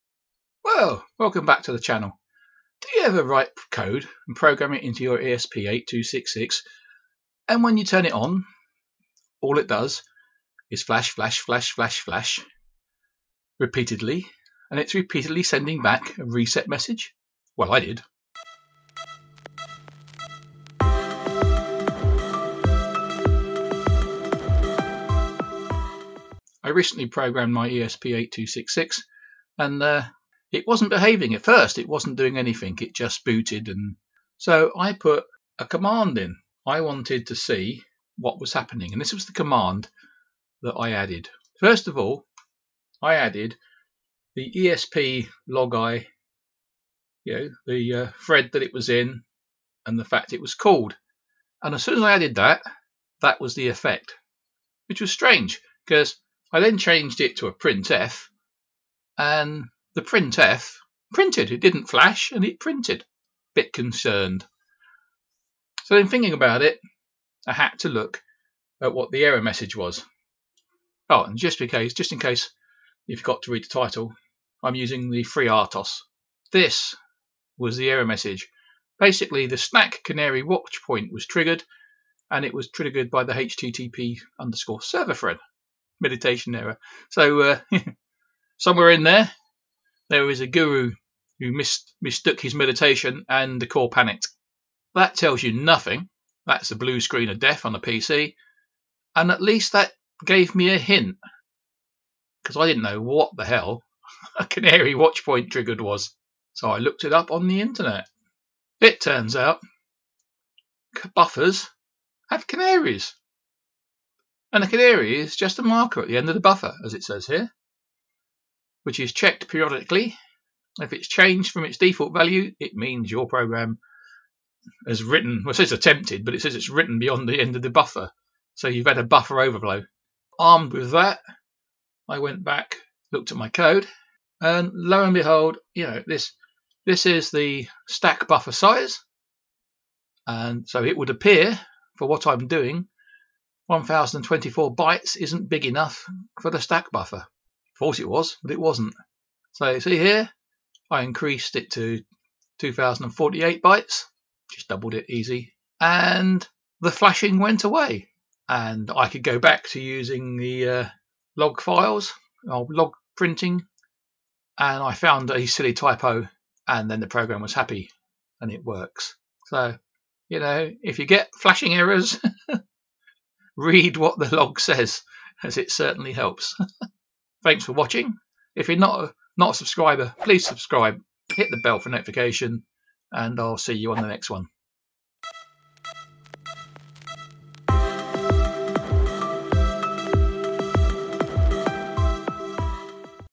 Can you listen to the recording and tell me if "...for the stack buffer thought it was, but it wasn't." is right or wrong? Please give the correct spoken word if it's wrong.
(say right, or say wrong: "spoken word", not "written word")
right.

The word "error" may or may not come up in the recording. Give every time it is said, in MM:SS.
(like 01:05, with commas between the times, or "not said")
01:09, 01:17, 01:26, 02:51.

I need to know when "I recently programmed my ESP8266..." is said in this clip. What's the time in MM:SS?
00:26.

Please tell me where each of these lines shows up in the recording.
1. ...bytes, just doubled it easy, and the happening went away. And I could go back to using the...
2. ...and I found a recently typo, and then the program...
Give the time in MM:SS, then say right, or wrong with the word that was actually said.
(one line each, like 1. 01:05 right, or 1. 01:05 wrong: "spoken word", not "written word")
1. 02:33 wrong: "flashing", not "happening"
2. 02:44 wrong: "silly", not "recently".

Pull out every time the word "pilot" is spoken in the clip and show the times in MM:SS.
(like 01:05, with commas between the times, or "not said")
not said.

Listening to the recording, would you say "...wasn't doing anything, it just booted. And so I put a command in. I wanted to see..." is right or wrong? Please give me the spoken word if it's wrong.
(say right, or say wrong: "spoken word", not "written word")
right.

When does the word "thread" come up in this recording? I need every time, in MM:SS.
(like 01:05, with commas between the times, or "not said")
00:48, 01:25.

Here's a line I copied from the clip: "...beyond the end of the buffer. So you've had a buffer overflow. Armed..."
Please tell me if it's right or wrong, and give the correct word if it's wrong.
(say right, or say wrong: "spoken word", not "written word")
right.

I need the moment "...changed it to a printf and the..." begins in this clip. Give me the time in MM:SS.
00:56.